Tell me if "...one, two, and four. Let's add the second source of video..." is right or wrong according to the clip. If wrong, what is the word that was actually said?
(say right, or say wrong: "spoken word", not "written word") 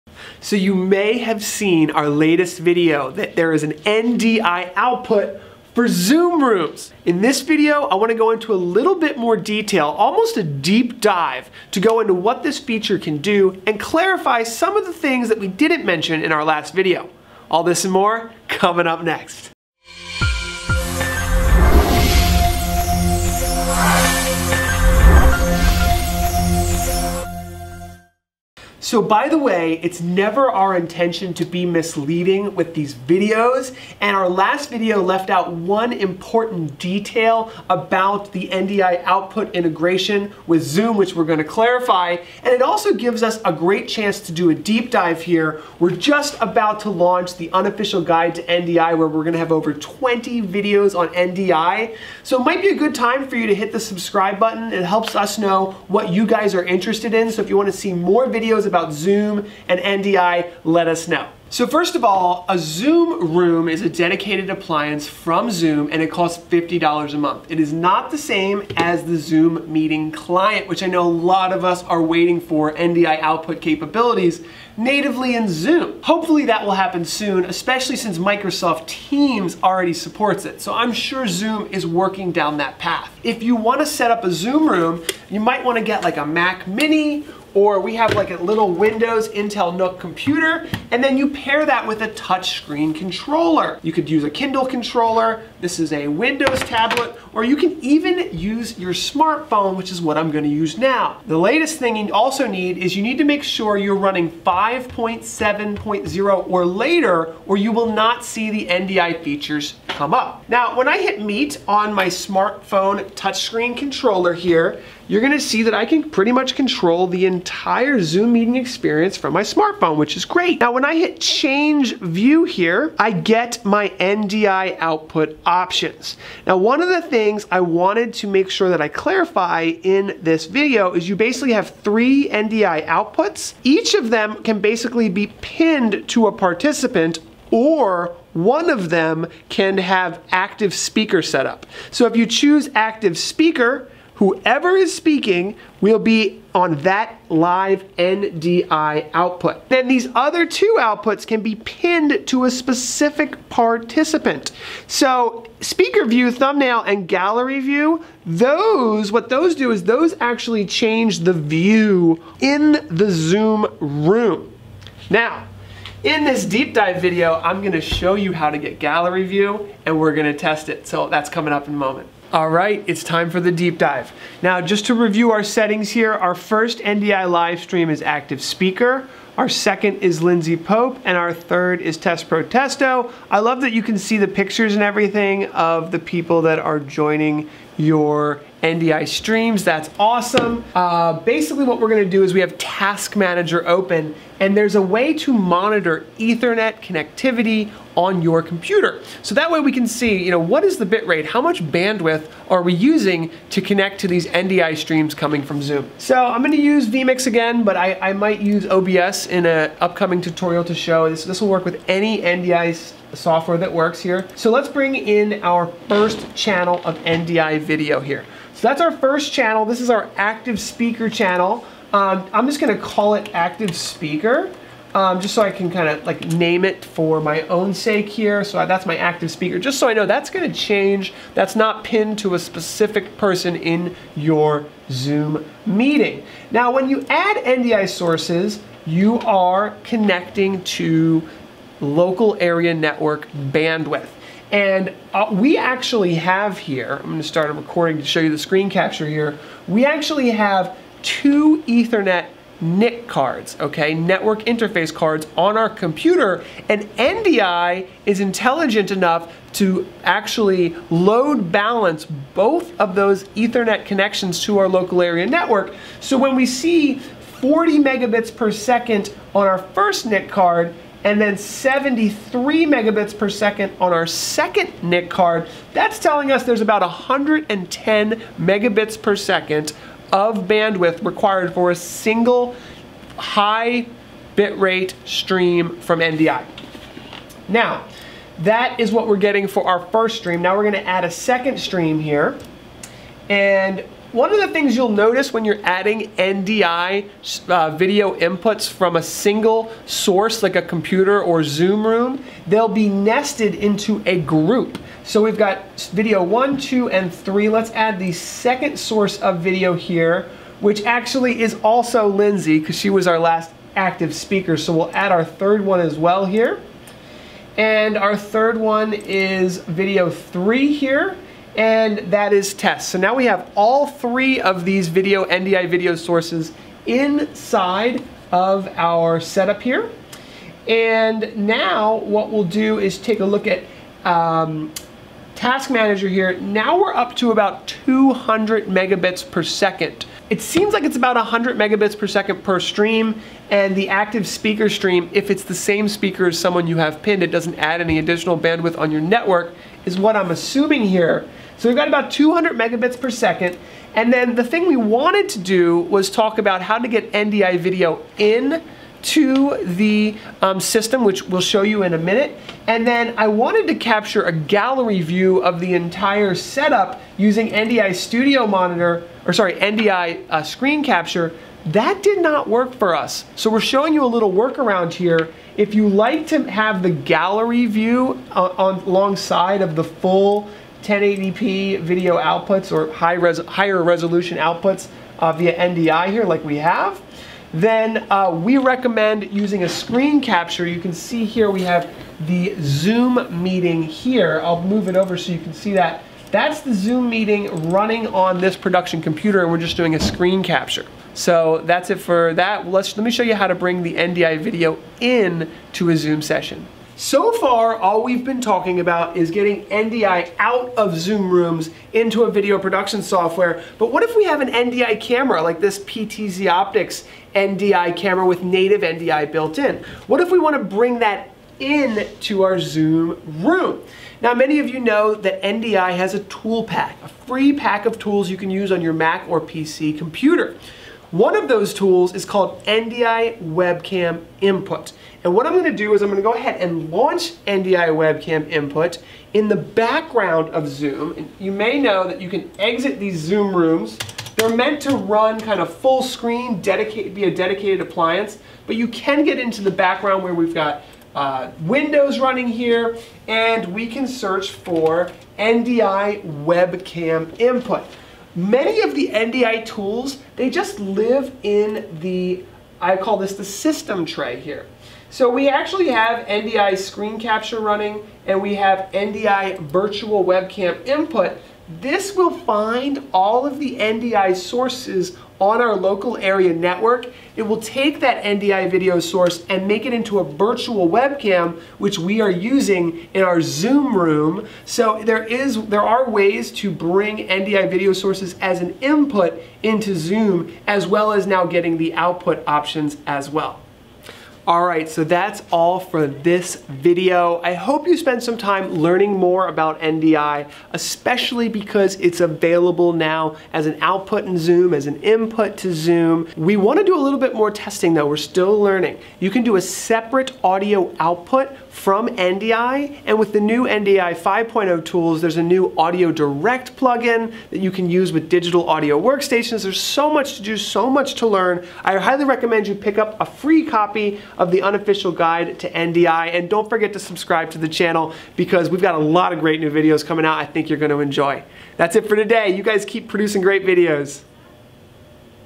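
wrong: "three", not "four".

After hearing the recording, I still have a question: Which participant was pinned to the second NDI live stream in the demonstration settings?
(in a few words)
Lindsay Pope.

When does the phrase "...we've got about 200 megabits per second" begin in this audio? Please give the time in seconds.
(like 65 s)
351 s.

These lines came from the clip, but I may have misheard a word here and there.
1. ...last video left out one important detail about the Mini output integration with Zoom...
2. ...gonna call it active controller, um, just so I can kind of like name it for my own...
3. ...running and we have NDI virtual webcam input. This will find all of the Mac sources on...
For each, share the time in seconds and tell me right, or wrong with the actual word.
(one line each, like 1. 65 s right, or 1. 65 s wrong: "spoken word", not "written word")
1. 34 s wrong: "NDI", not "Mini"
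2. 222 s wrong: "speaker", not "controller"
3. 467 s wrong: "NDI", not "Mac".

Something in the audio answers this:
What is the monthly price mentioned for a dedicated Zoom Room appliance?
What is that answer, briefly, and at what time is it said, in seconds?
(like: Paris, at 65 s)
$50 a month, at 66 s.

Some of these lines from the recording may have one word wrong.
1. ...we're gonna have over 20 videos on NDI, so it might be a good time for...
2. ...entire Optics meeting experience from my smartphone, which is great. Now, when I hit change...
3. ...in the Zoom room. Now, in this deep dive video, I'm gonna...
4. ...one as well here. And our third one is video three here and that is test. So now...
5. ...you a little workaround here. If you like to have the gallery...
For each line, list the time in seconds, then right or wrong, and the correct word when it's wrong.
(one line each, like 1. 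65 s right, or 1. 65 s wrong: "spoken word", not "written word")
1. 49 s right
2. 117 s wrong: "Zoom", not "Optics"
3. 162 s right
4. 315 s right
5. 373 s right.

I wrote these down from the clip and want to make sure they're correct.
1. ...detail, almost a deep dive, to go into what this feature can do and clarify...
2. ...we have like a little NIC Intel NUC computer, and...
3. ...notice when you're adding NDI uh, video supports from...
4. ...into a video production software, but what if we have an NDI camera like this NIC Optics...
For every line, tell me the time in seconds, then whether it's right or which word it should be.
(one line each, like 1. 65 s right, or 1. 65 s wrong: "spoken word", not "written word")
1. 9 s right
2. 87 s wrong: "Windows", not "NIC"
3. 294 s wrong: "inputs", not "supports"
4. 411 s wrong: "PTZ", not "NIC".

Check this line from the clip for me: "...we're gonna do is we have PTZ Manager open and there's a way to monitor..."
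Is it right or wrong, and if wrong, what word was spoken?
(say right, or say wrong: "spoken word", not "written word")
wrong: "Task", not "PTZ".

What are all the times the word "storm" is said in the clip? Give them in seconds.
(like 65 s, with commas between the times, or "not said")
not said.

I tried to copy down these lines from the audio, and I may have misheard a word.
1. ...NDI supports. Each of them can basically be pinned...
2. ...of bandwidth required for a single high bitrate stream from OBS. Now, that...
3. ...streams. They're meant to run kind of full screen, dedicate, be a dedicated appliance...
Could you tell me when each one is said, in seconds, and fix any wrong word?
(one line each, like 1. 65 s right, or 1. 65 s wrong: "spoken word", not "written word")
1. 132 s wrong: "outputs", not "supports"
2. 280 s wrong: "NDI", not "OBS"
3. 443 s wrong: "rooms", not "streams".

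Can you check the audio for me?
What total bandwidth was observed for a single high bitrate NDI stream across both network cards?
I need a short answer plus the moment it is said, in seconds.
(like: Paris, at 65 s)
110 megabits per second, at 276 s.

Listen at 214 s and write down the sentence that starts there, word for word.
So let's bring in our first channel of NDI video here.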